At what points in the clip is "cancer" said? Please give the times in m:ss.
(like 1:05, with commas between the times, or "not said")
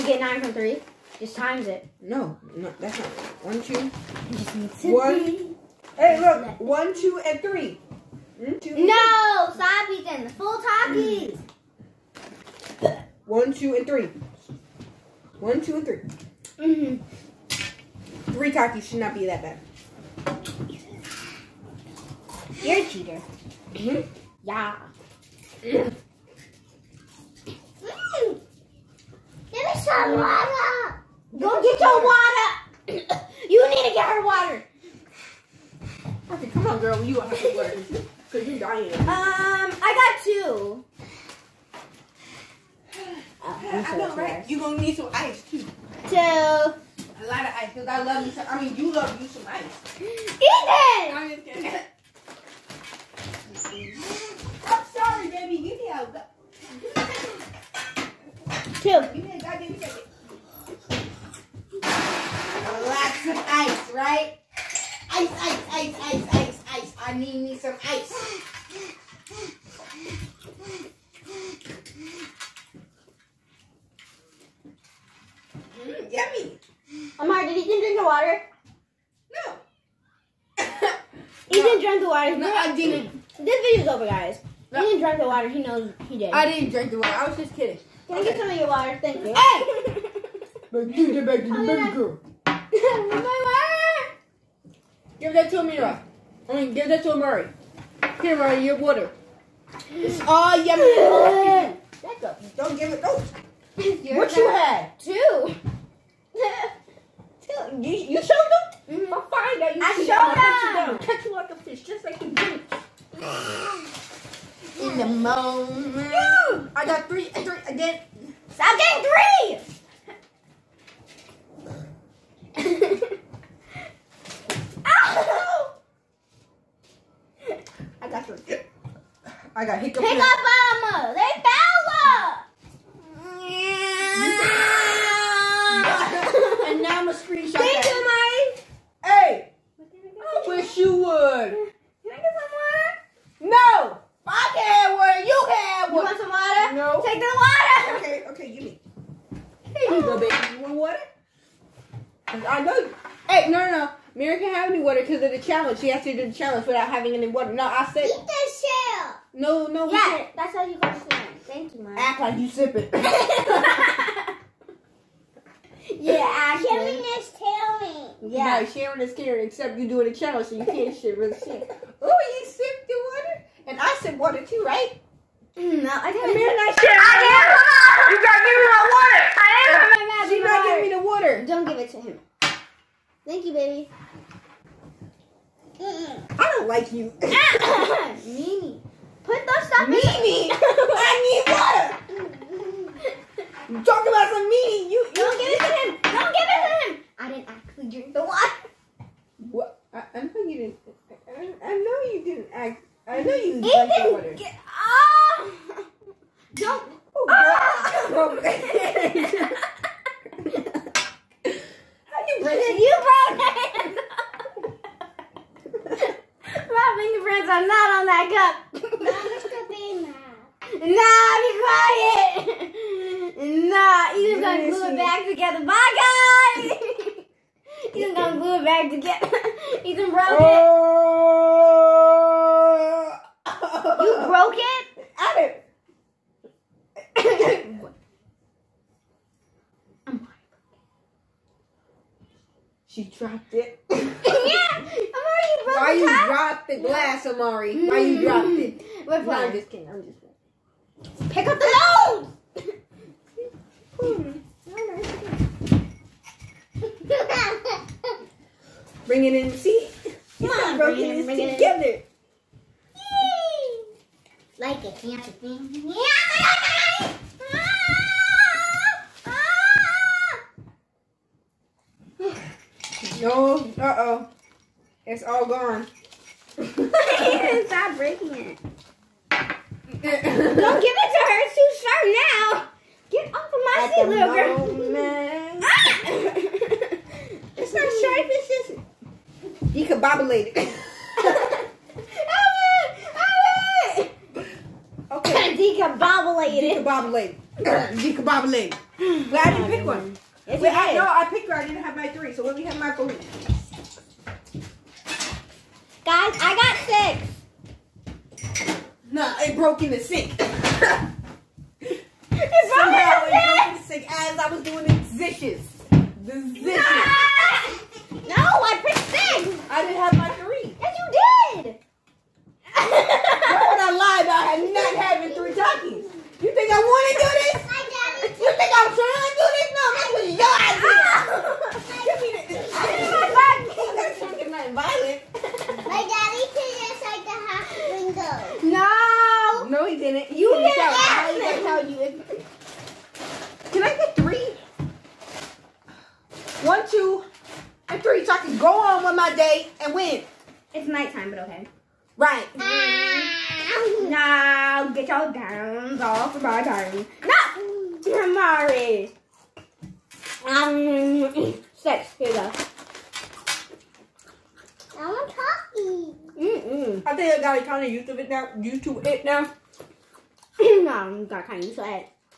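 4:24.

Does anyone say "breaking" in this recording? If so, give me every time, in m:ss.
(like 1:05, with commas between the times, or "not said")
4:37.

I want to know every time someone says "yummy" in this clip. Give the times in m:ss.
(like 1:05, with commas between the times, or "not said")
1:16, 1:40.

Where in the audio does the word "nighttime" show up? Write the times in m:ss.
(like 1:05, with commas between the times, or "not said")
5:50.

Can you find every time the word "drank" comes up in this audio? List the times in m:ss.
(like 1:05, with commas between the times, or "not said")
1:21.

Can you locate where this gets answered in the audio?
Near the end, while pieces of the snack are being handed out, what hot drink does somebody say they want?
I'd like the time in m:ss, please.
6:05.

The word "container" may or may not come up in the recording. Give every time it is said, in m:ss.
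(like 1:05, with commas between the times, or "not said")
not said.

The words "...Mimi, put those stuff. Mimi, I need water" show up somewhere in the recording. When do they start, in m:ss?
3:08.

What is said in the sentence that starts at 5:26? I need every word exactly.
You think I want to do this?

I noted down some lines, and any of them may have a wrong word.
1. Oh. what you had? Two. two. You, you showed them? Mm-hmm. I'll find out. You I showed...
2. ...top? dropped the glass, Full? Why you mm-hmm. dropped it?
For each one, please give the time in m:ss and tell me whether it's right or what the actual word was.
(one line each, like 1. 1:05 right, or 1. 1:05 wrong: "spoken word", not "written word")
1. 1:43 right
2. 4:06 wrong: "Amari", not "Full".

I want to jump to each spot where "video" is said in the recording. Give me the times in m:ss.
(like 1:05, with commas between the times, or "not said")
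1:23.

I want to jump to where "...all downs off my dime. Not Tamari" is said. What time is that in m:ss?
5:55.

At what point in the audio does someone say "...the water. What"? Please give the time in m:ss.
3:18.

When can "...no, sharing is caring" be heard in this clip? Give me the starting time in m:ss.
2:48.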